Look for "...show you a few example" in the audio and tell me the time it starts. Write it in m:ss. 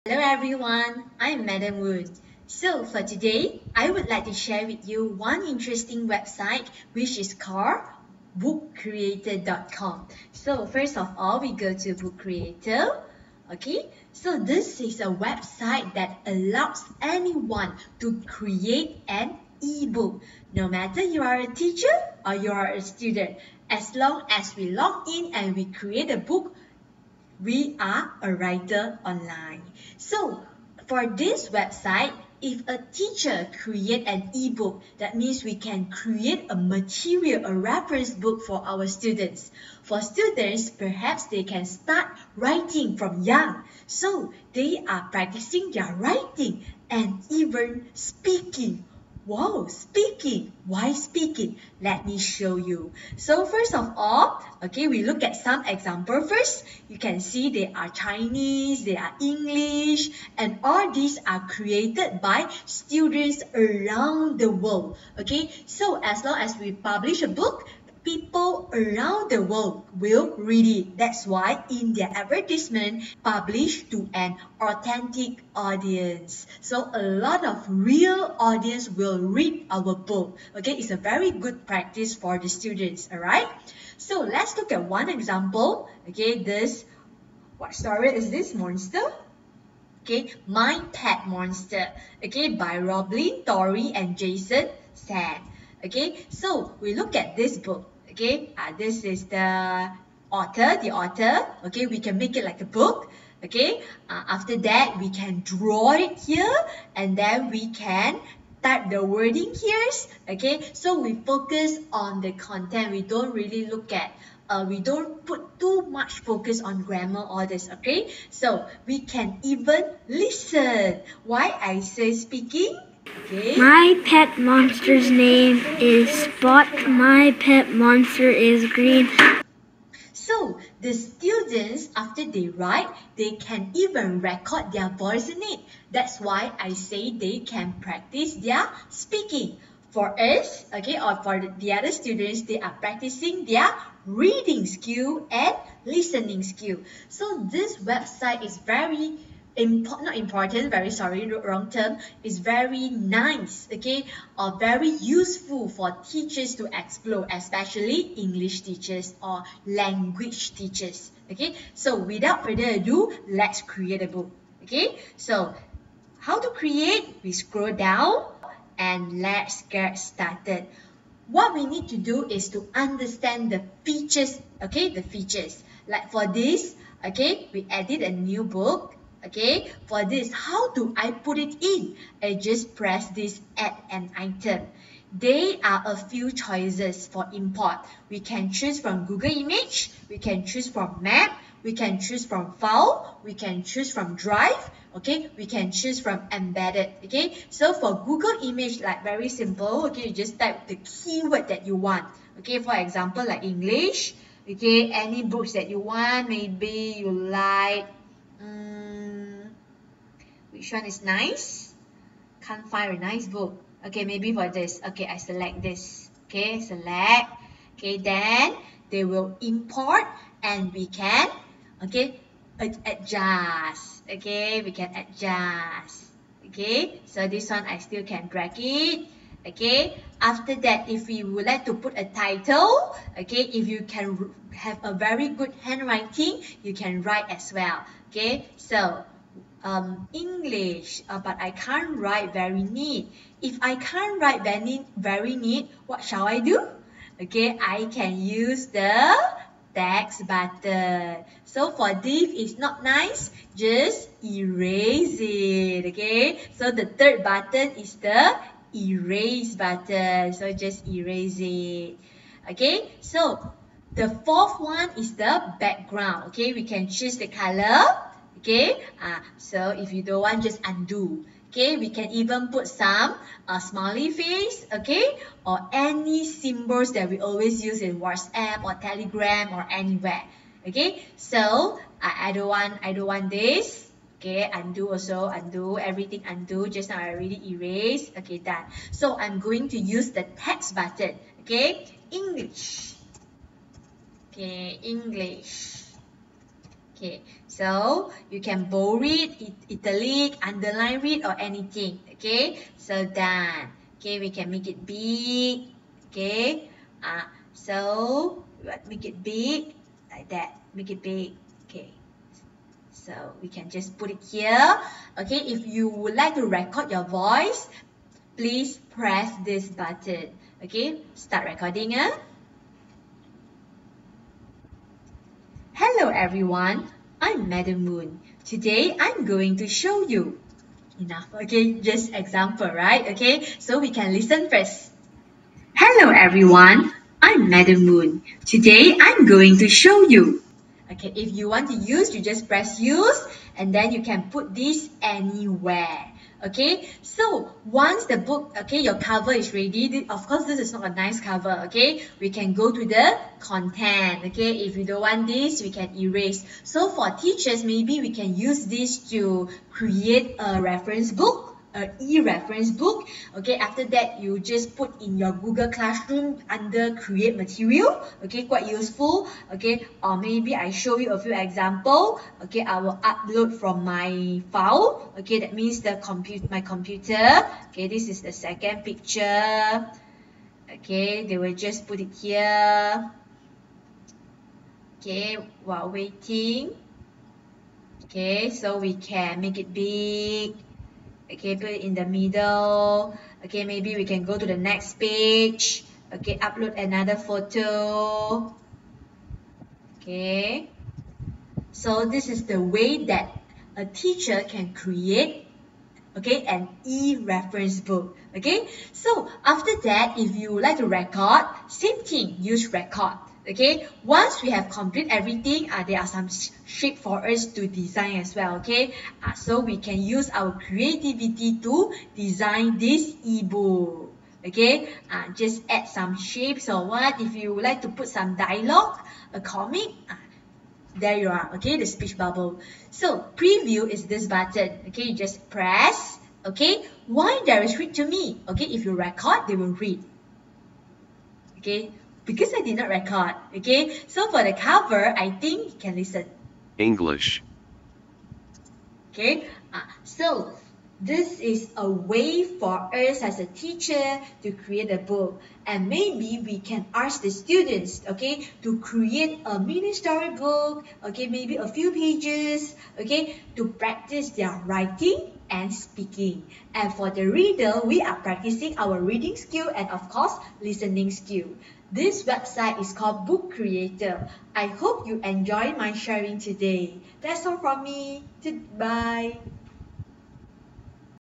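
6:10.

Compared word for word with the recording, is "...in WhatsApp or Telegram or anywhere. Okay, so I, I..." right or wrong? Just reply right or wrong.
right.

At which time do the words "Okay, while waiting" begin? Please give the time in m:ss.
6:24.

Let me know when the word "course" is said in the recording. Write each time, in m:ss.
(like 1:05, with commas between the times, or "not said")
5:50, 7:50.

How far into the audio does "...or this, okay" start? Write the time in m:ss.
1:57.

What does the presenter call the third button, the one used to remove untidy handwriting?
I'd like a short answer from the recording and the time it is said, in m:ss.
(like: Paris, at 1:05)
erase button, at 4:18.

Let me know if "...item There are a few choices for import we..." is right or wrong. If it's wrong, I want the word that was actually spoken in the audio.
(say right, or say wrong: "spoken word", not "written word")
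right.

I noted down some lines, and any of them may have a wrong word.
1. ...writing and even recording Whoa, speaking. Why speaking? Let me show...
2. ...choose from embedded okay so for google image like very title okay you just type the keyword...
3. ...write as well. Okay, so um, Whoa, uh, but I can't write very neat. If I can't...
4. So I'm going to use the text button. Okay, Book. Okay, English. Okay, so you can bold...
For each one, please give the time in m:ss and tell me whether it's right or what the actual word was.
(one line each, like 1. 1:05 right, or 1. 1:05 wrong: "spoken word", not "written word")
1. 0:45 wrong: "speaking", not "recording"
2. 3:15 wrong: "simple", not "title"
3. 3:57 wrong: "English", not "Whoa"
4. 4:48 wrong: "English", not "Book".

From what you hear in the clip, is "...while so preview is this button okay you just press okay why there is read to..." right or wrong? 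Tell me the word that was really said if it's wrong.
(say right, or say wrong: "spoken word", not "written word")
wrong: "bubble", not "while".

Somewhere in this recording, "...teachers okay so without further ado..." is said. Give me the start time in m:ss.
2:40.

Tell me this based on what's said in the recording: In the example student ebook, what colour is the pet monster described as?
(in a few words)
green.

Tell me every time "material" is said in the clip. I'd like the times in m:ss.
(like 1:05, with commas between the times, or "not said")
0:36, 6:07.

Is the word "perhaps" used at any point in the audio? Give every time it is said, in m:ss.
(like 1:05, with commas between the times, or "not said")
0:40.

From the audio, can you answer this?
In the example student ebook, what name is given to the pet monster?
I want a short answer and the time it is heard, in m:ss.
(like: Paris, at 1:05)
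Spot, at 2:06.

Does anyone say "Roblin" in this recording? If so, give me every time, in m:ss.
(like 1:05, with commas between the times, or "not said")
1:32.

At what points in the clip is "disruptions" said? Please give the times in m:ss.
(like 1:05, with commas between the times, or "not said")
not said.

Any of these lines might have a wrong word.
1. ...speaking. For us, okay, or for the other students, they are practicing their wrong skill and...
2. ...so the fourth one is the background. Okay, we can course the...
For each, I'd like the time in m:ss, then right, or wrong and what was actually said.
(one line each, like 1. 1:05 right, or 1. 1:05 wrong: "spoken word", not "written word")
1. 2:18 wrong: "reading", not "wrong"
2. 4:23 wrong: "choose", not "course".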